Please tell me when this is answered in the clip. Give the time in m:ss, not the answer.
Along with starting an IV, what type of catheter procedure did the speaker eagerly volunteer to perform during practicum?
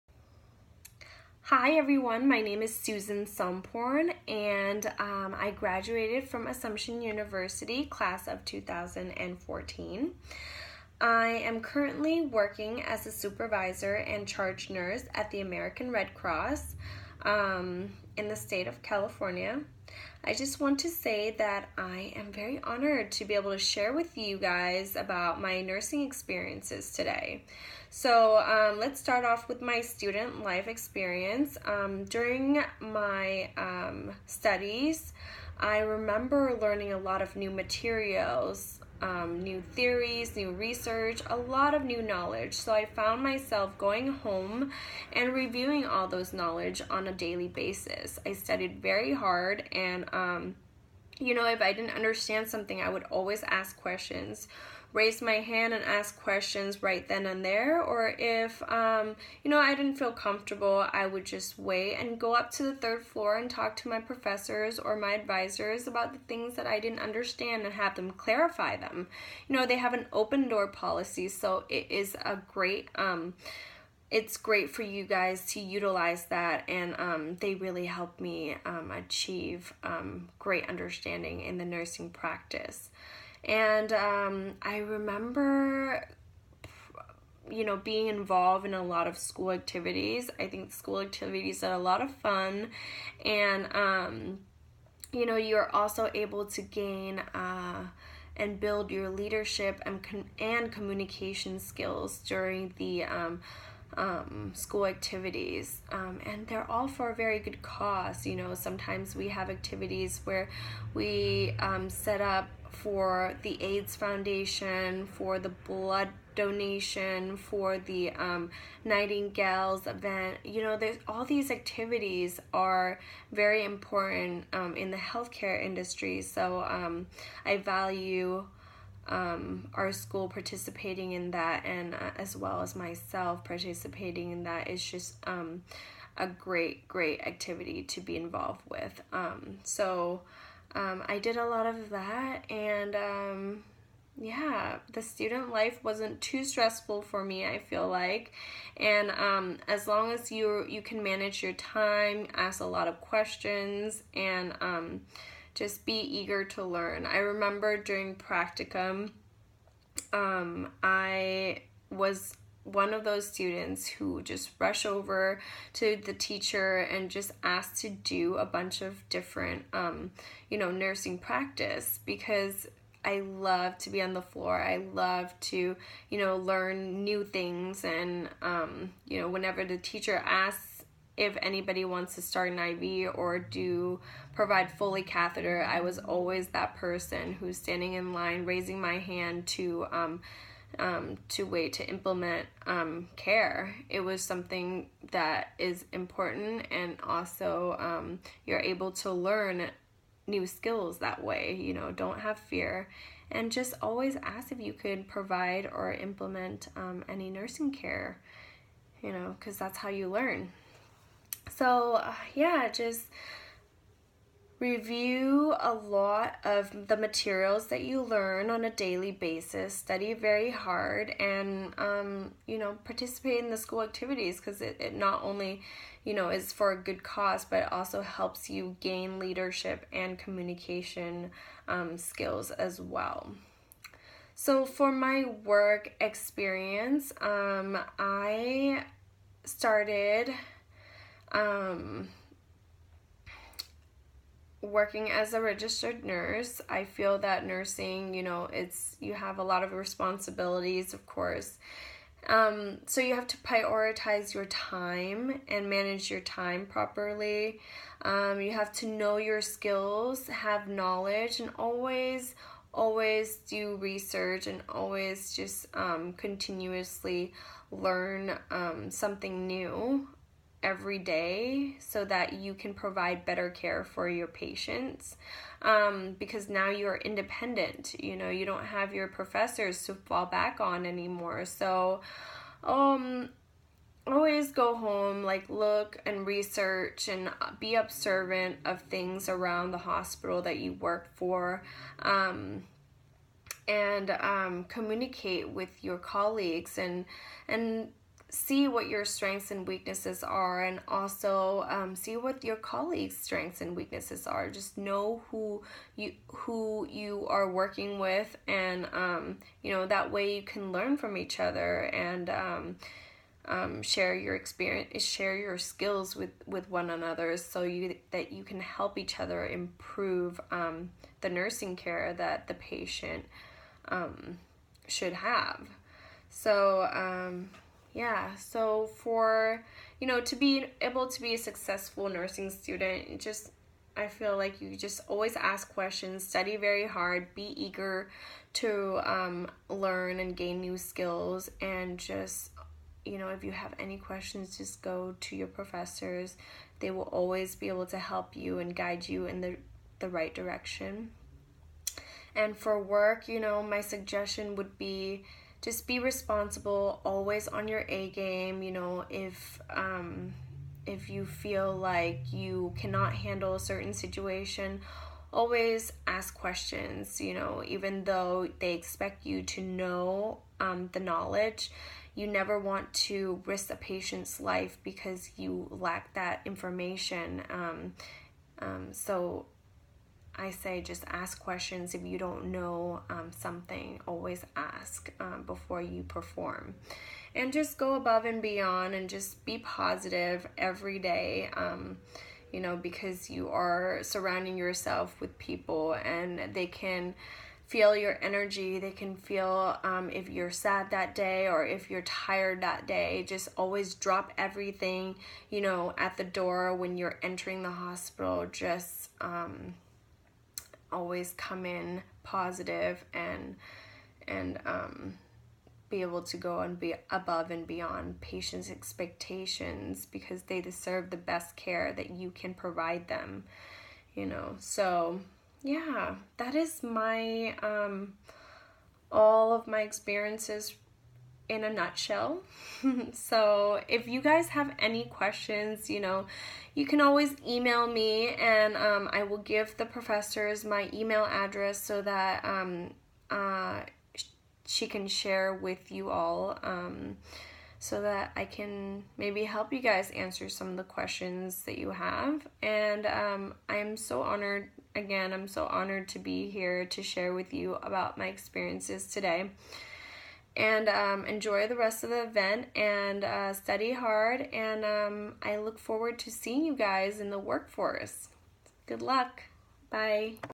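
3:04.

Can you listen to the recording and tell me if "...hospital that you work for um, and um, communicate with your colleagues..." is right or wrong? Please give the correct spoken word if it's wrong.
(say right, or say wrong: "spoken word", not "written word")
right.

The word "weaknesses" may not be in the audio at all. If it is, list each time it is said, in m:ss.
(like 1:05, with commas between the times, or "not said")
4:59, 5:03.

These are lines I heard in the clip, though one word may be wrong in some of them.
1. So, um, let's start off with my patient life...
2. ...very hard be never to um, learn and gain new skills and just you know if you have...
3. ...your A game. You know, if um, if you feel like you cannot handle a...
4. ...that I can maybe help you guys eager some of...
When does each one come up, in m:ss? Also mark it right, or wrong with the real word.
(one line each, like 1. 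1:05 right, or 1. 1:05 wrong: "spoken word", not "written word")
1. 0:27 wrong: "student", not "patient"
2. 5:36 wrong: "eager", not "never"
3. 5:57 right
4. 7:28 wrong: "answer", not "eager".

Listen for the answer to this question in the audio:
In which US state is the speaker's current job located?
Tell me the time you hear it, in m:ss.
0:18.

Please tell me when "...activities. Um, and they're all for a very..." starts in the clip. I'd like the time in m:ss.
1:44.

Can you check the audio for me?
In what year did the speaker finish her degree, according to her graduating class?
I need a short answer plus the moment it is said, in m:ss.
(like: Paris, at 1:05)
2014, at 0:08.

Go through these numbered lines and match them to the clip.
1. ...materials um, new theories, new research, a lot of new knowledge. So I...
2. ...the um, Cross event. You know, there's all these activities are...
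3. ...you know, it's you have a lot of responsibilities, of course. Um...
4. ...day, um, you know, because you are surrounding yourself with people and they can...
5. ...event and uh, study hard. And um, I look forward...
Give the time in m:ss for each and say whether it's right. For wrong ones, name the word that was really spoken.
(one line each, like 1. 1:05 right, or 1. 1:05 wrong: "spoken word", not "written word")
1. 0:37 right
2. 1:57 wrong: "Nightingales", not "Cross"
3. 4:08 right
4. 6:30 right
5. 7:42 right.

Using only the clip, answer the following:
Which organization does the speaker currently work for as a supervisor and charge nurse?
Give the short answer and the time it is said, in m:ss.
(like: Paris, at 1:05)
American Red Cross, at 0:15.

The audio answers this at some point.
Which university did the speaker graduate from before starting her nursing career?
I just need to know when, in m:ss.
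0:06.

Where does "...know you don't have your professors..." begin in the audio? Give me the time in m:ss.
4:38.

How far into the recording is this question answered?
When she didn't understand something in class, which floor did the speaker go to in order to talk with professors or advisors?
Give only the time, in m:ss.
1:02.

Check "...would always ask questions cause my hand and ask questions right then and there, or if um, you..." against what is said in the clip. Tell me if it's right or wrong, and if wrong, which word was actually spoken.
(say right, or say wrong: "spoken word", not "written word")
wrong: "raise", not "cause".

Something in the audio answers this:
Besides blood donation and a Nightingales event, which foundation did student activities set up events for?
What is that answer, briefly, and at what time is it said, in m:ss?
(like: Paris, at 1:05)
AIDS Foundation, at 1:53.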